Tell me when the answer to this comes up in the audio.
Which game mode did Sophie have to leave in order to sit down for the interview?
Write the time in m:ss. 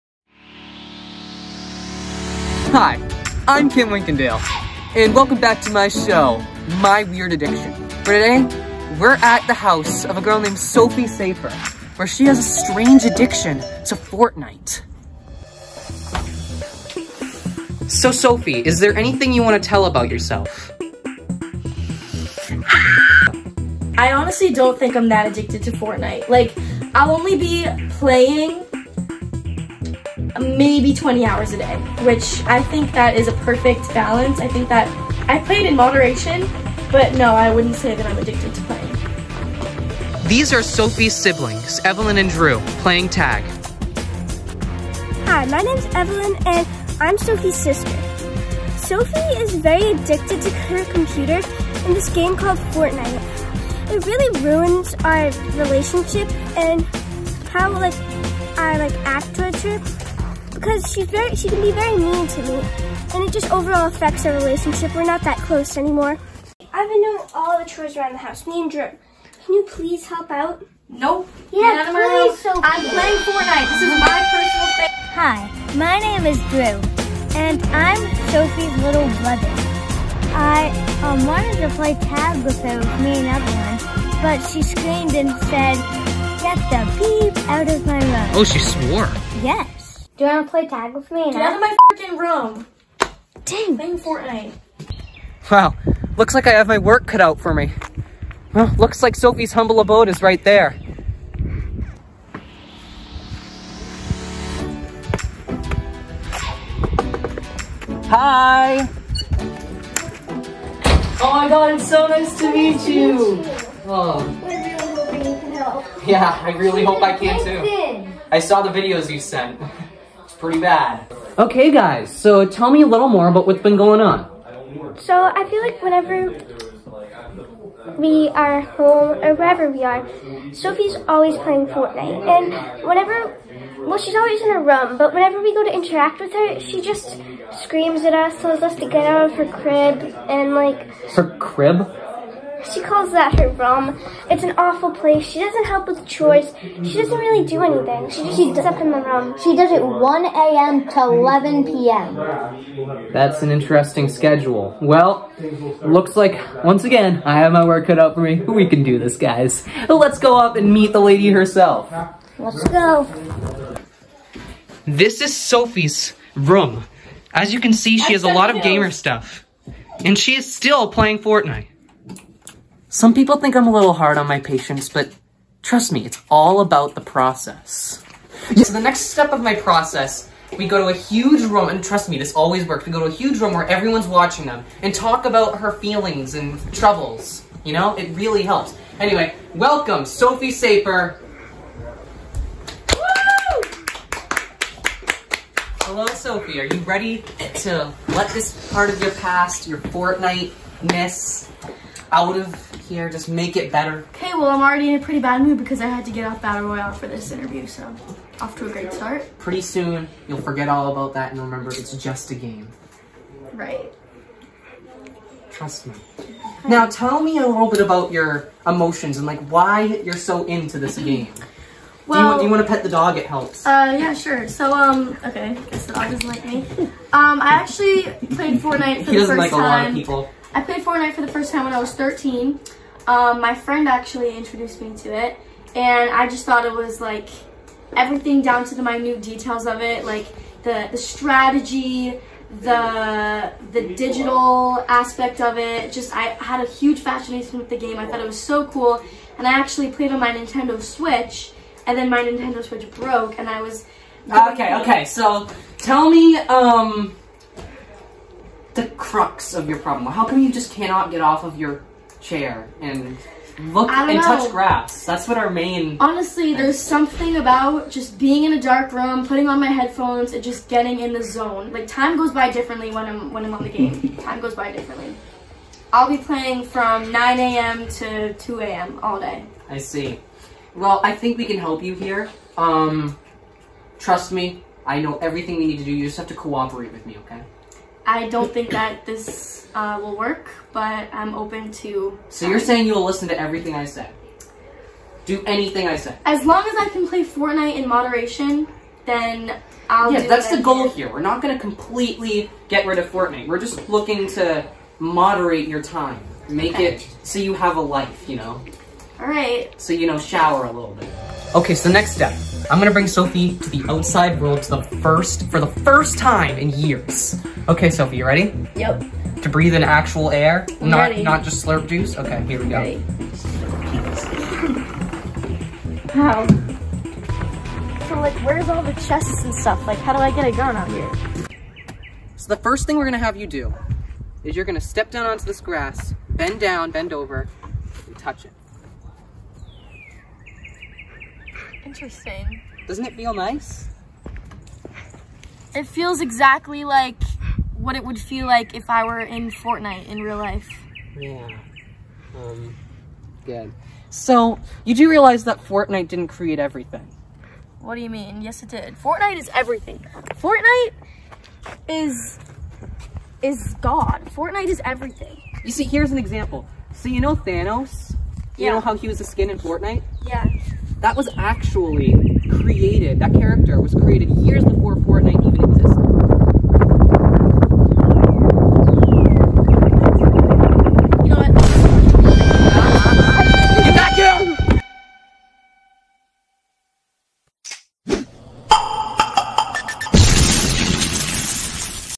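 3:26.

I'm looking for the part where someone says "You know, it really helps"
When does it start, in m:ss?
3:07.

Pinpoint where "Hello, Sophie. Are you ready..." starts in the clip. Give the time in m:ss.
3:15.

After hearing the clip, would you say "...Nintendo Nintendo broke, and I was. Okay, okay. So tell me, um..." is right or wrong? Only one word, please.
wrong.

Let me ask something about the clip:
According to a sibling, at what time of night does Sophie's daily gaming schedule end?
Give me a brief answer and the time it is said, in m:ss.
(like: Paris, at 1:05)
11 p.m., at 2:31.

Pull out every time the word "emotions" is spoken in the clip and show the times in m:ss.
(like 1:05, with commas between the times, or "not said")
3:38.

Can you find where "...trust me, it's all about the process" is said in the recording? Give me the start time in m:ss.
2:55.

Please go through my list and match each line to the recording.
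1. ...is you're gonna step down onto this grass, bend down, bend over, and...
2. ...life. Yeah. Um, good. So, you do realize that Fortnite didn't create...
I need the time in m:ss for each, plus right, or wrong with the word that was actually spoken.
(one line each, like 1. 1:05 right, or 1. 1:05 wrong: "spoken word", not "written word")
1. 5:34 right
2. 5:50 right.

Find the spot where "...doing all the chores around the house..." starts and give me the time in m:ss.
1:07.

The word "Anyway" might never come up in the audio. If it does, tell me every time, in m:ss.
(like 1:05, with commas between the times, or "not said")
3:08.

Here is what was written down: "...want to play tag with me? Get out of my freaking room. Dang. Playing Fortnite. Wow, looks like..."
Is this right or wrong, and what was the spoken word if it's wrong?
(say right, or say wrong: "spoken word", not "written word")
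right.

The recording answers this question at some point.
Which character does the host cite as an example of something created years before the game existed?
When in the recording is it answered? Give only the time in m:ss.
6:07.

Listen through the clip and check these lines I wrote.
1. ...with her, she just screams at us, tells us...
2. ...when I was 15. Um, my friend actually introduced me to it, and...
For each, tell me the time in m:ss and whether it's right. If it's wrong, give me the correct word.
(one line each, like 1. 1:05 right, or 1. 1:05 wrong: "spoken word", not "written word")
1. 2:16 right
2. 3:51 wrong: "13", not "15".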